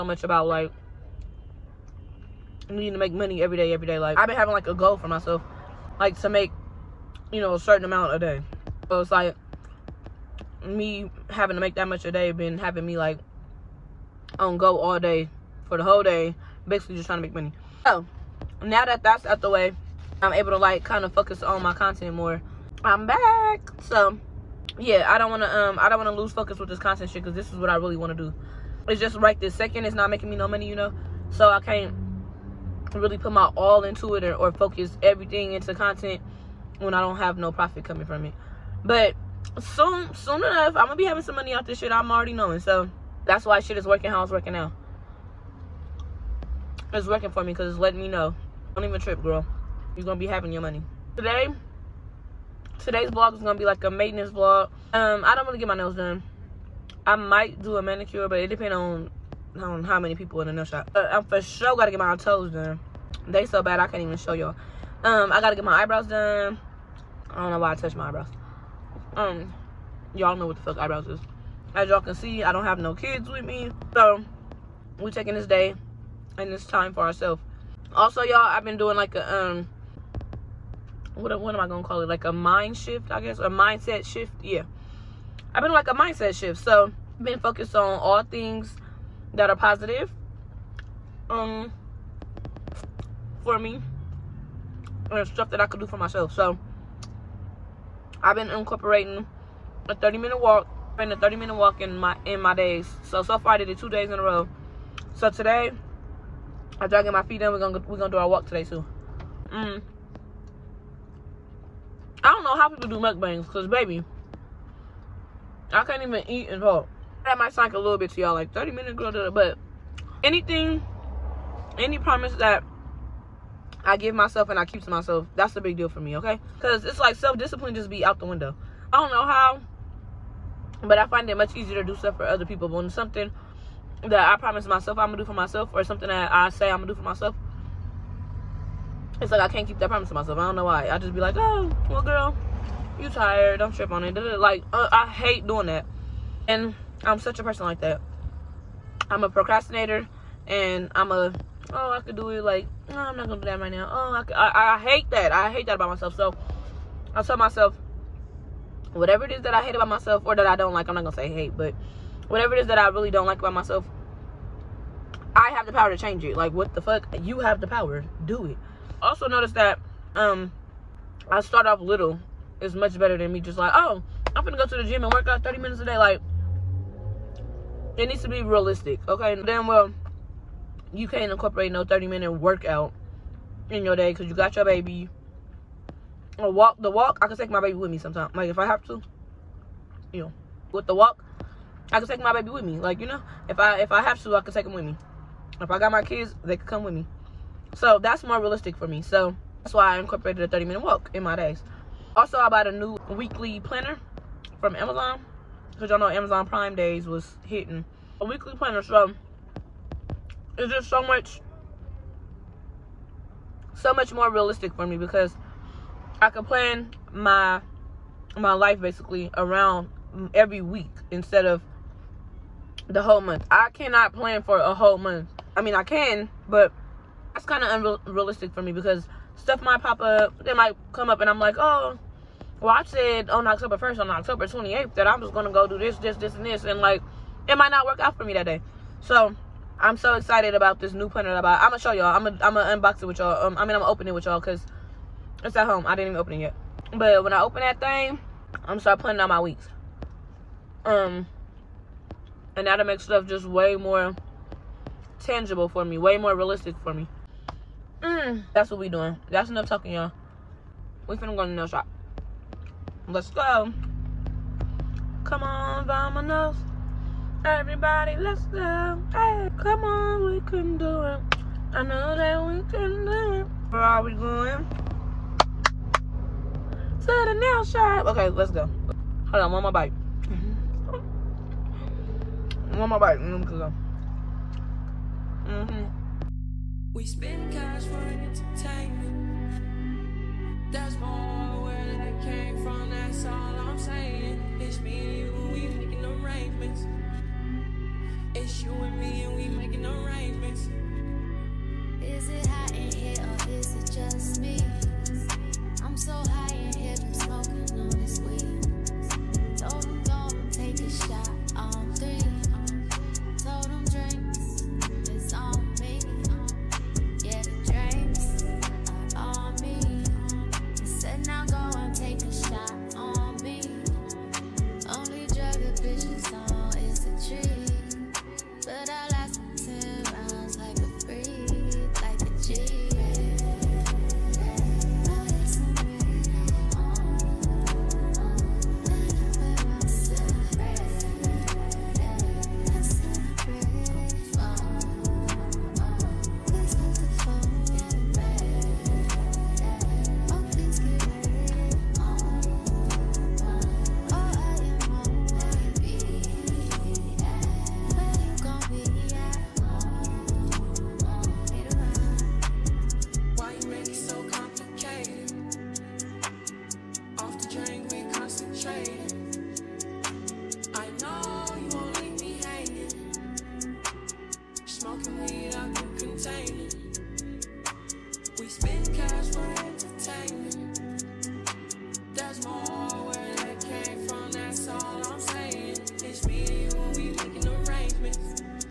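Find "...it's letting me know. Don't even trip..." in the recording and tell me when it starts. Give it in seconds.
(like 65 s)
47 s.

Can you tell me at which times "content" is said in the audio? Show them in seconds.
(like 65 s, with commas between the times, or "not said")
21 s, 26 s, 35 s.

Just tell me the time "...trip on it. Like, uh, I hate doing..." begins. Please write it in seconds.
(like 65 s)
143 s.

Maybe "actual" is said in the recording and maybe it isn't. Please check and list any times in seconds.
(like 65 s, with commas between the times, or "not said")
not said.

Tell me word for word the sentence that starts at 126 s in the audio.
Because it's like self discipline just be out the window.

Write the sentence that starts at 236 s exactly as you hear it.
And, like, it might not work out for me that day.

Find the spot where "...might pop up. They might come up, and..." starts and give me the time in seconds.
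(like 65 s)
229 s.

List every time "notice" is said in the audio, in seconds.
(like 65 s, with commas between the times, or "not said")
169 s.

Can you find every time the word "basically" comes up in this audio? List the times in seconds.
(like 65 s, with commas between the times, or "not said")
16 s, 218 s.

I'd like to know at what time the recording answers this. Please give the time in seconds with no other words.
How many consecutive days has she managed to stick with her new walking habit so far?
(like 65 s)
103 s.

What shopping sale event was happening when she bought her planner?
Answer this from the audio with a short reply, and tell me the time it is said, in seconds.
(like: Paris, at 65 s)
Amazon Prime Days, at 206 s.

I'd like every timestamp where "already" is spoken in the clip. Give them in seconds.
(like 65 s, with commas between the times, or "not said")
42 s.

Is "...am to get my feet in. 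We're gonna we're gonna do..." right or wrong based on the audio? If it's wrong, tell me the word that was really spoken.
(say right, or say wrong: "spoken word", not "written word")
right.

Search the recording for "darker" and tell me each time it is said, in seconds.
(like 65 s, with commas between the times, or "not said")
not said.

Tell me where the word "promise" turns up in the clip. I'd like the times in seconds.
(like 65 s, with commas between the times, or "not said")
121 s, 134 s, 139 s.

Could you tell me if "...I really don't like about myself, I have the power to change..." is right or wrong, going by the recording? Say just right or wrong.
right.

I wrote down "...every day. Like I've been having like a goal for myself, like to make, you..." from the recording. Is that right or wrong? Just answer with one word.
right.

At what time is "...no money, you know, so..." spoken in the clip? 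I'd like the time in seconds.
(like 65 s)
30 s.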